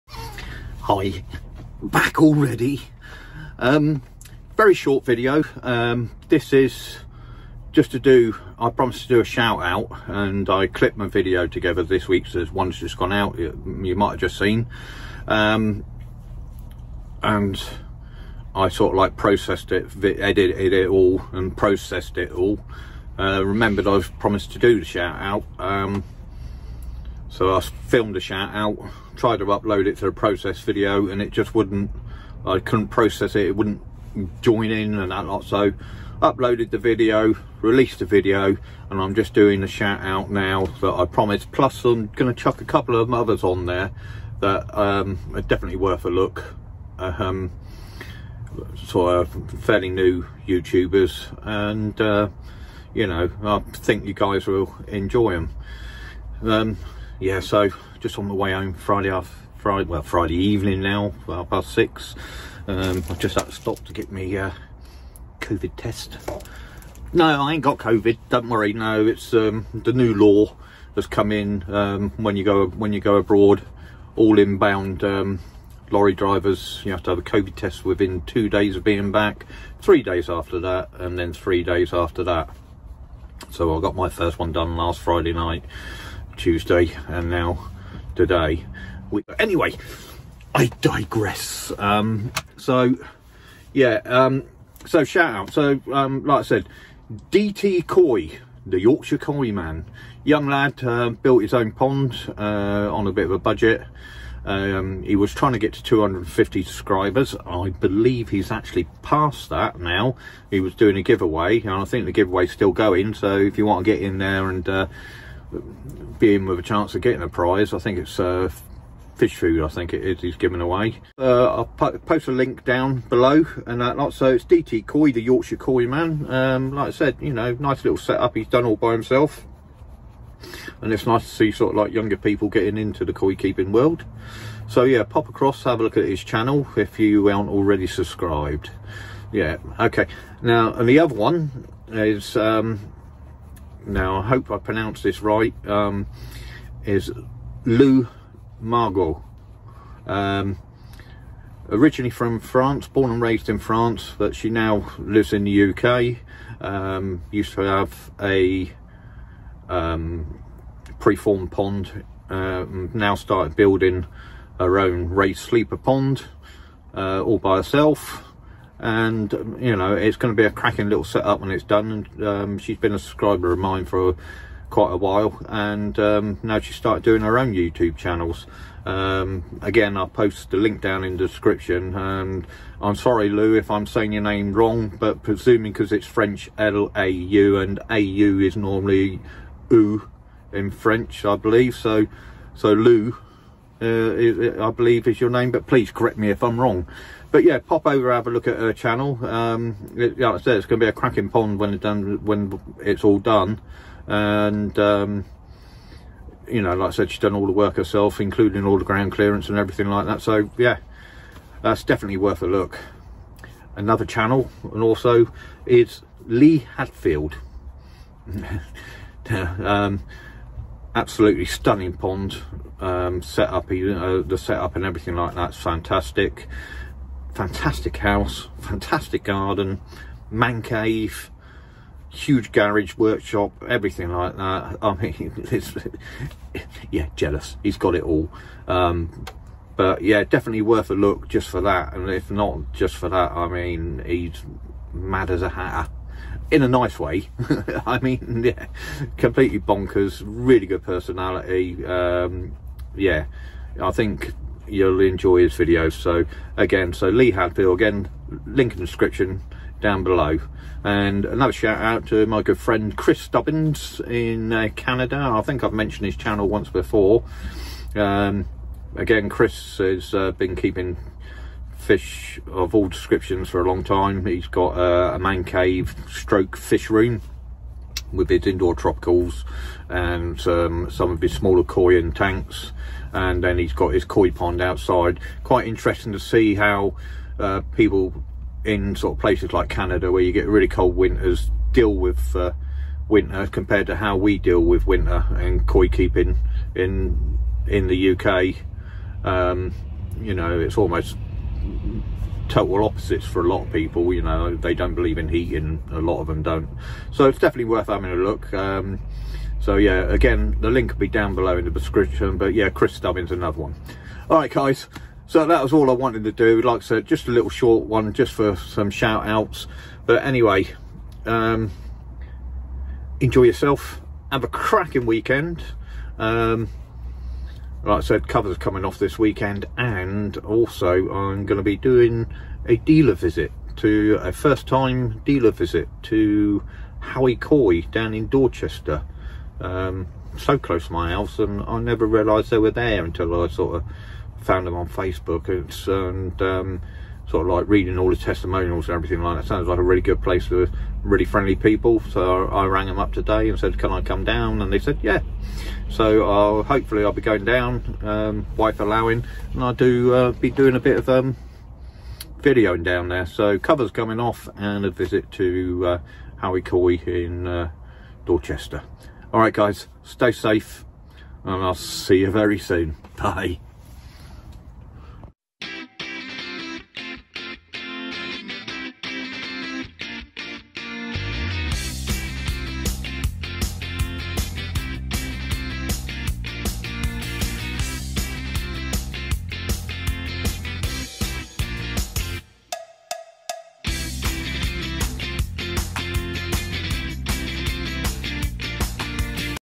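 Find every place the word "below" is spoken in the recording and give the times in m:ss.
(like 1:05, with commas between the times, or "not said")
2:03, 4:20, 5:11.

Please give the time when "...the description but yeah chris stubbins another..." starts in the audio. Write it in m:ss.
5:11.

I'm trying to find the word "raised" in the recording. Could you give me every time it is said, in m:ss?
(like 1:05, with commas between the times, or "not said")
2:33, 2:45.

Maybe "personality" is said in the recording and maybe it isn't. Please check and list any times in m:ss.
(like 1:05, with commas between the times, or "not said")
4:10.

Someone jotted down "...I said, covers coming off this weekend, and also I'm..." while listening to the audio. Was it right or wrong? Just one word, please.
right.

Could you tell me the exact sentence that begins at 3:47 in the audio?
Fantastic house, fantastic garden, man cave, huge garage, workshop, everything like that.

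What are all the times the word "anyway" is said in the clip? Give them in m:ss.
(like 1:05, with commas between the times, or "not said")
1:29, 5:20.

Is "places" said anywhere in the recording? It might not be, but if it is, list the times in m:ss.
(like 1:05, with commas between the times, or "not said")
4:49, 5:50.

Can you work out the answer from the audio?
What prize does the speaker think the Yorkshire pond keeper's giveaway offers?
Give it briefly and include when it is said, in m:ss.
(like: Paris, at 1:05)
Fish food, at 1:59.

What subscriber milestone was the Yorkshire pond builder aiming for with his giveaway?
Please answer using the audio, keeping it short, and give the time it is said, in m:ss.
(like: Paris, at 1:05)
250, at 1:45.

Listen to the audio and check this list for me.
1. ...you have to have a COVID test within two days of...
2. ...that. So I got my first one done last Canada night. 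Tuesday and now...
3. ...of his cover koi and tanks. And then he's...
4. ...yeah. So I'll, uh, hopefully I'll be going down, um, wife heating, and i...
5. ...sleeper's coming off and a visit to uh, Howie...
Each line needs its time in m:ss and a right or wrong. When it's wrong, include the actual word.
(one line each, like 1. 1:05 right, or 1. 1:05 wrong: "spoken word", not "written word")
1. 1:16 right
2. 1:22 wrong: "Friday", not "Canada"
3. 4:41 wrong: "smaller", not "cover"
4. 5:55 wrong: "allowing", not "heating"
5. 6:03 wrong: "cover", not "sleeper".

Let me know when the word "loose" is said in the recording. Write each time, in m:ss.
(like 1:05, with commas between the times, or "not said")
not said.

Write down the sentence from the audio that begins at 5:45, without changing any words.
It's, and um, sort of like reading all the testimonials and everything like that.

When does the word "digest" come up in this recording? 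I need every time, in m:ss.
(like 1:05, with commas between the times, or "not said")
not said.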